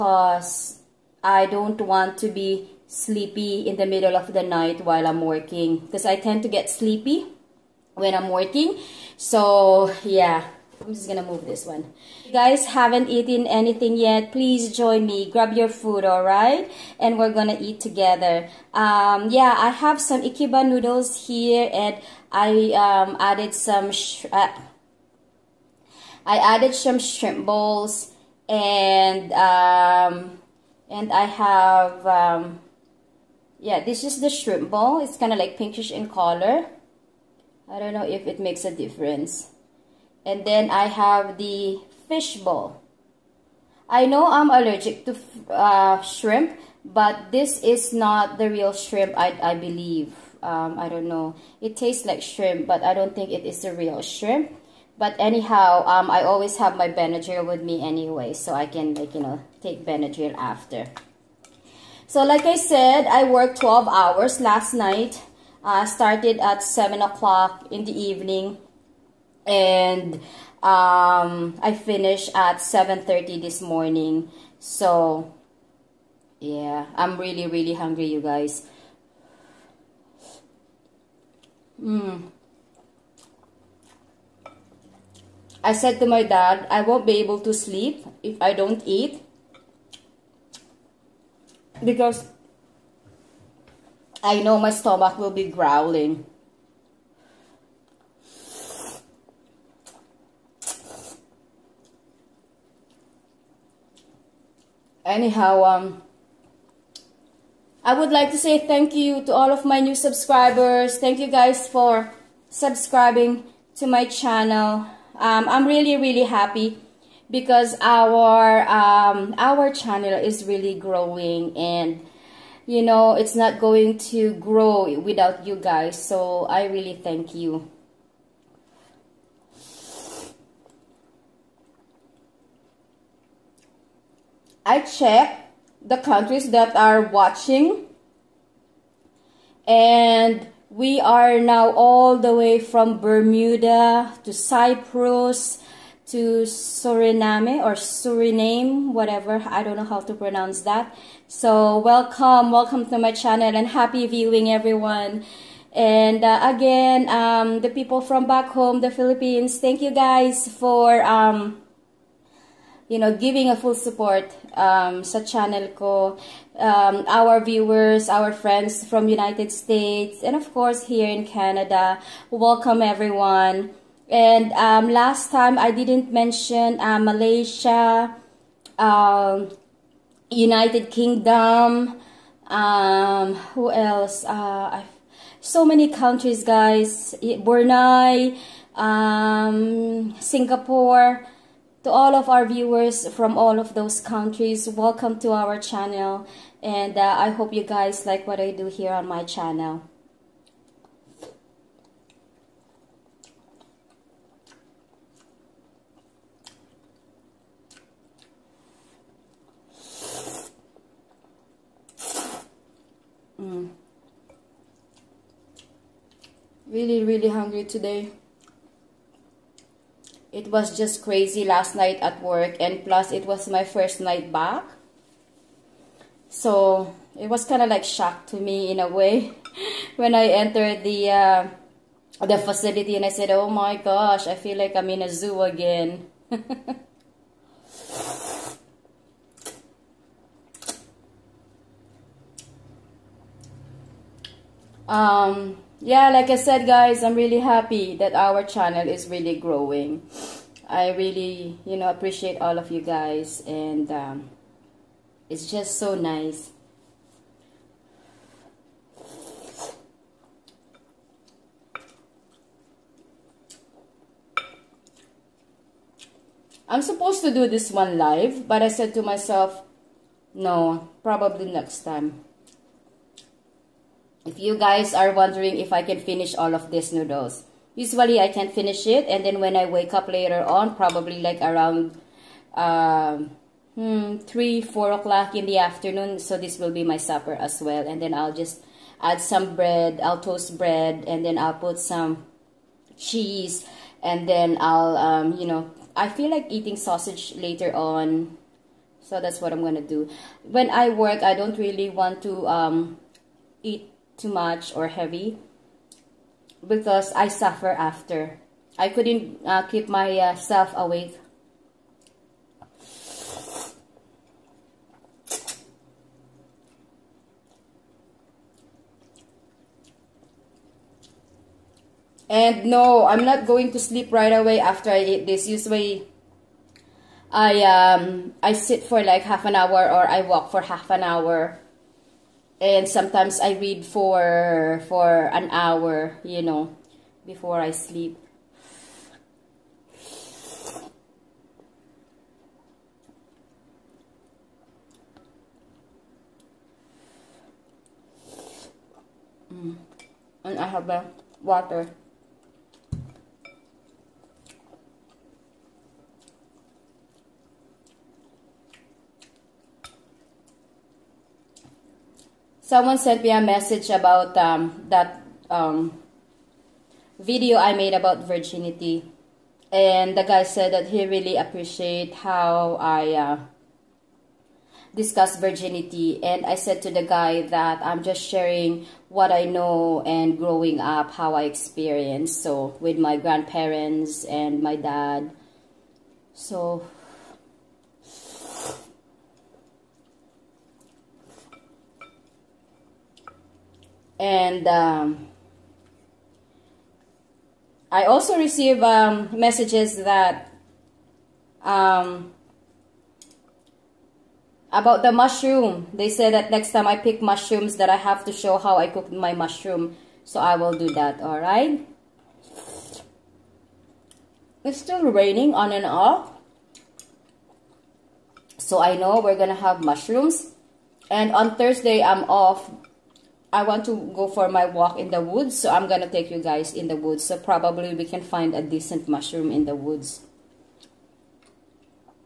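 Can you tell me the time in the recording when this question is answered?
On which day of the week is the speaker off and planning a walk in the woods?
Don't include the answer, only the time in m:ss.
7:01.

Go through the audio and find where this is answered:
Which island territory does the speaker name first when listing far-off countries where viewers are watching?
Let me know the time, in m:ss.
2:22.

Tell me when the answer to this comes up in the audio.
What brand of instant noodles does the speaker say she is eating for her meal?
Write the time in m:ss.
0:20.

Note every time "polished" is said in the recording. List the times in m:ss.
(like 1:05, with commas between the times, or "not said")
not said.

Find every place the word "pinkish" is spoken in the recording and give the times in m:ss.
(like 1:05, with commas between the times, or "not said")
0:35.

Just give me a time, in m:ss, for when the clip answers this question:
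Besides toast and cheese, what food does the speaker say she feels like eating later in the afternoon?
4:56.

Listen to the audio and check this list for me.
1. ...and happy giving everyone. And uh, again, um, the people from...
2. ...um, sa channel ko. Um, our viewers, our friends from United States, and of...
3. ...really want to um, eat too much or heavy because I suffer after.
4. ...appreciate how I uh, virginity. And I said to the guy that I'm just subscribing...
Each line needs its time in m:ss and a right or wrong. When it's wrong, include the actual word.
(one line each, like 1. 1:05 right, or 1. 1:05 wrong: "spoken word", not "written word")
1. 2:33 wrong: "viewing", not "giving"
2. 2:44 right
3. 5:01 right
4. 6:11 wrong: "sharing", not "subscribing".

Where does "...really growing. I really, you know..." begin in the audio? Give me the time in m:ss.
4:09.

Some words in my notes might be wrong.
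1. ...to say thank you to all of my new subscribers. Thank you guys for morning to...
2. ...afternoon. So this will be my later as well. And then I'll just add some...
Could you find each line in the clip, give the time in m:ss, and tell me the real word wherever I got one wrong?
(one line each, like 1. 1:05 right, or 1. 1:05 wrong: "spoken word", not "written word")
1. 1:48 wrong: "subscribing", not "morning"
2. 4:45 wrong: "supper", not "later".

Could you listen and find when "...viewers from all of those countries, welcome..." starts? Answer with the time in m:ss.
3:12.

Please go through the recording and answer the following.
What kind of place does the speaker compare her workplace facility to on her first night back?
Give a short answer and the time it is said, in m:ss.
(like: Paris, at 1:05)
a zoo, at 3:55.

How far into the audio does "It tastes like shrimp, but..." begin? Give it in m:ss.
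0:51.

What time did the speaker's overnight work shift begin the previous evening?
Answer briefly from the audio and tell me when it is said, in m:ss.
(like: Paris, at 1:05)
7 o'clock, at 1:06.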